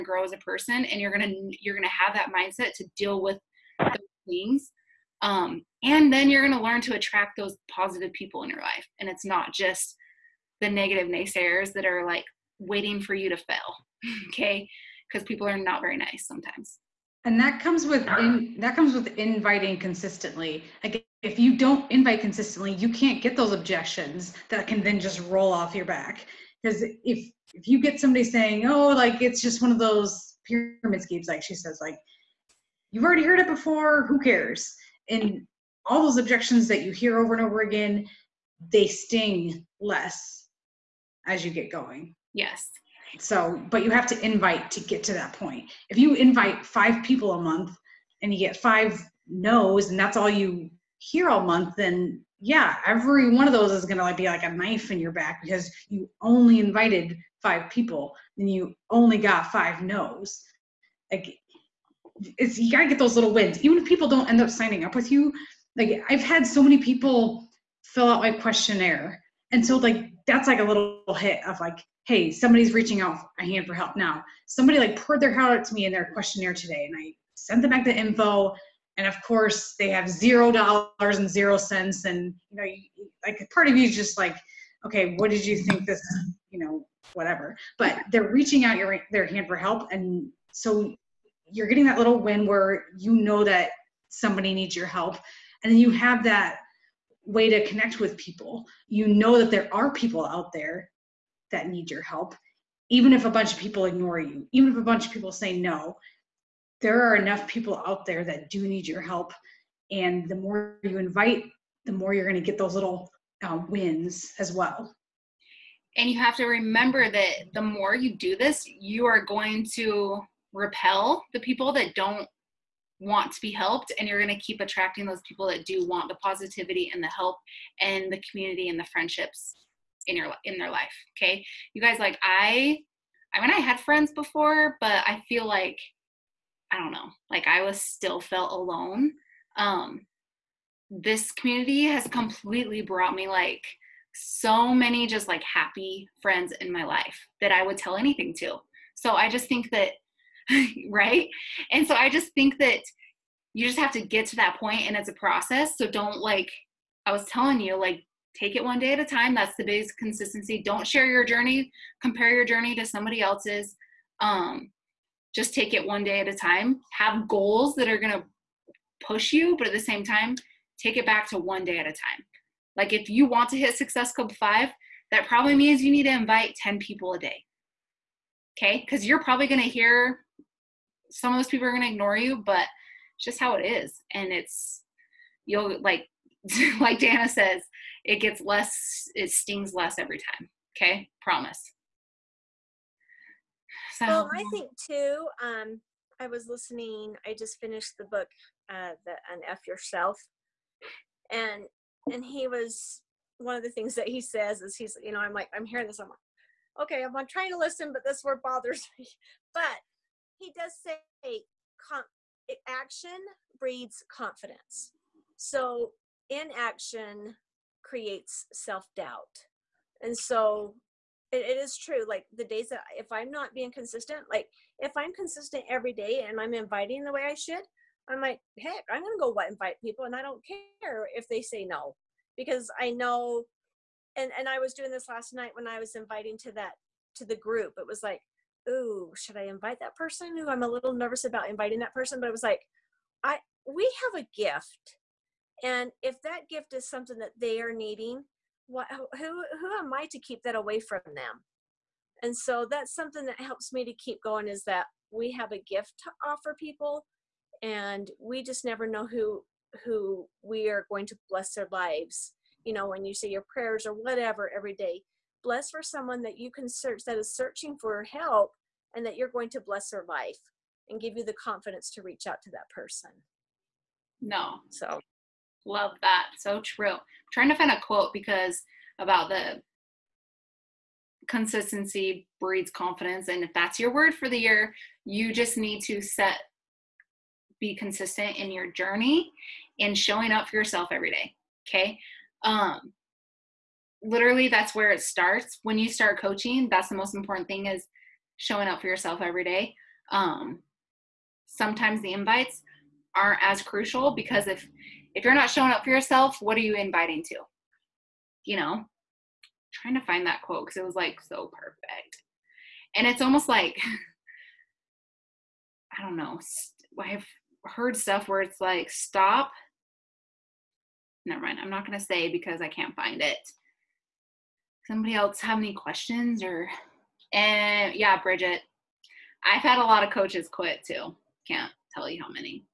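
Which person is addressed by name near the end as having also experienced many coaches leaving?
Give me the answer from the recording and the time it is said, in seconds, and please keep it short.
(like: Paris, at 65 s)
Bridget, at 328 s.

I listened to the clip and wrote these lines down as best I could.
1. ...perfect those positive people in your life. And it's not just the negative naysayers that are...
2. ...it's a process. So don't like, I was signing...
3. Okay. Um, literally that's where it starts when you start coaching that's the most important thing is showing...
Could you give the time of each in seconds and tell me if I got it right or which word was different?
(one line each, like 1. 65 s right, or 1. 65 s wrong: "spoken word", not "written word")
1. 6 s wrong: "attract", not "perfect"
2. 154 s wrong: "telling", not "signing"
3. 291 s right.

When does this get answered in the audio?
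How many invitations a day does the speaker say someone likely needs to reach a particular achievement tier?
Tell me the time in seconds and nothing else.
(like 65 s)
176 s.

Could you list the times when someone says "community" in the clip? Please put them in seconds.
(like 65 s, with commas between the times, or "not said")
128 s, 141 s.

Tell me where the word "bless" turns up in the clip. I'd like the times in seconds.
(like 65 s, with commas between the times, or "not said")
261 s, 265 s, 269 s.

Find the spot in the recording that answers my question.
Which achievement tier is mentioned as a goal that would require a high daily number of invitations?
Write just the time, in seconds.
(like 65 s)
173 s.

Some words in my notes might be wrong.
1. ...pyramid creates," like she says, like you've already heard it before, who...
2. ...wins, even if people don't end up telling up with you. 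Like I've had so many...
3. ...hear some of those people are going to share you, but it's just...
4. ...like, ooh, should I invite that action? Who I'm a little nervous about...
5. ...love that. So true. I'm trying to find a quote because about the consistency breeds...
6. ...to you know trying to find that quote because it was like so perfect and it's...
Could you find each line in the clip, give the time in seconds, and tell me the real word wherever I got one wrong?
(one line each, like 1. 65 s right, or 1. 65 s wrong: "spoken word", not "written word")
1. 30 s wrong: "schemes", not "creates"
2. 63 s wrong: "signing", not "telling"
3. 179 s wrong: "ignore", not "share"
4. 238 s wrong: "person", not "action"
5. 275 s right
6. 307 s right.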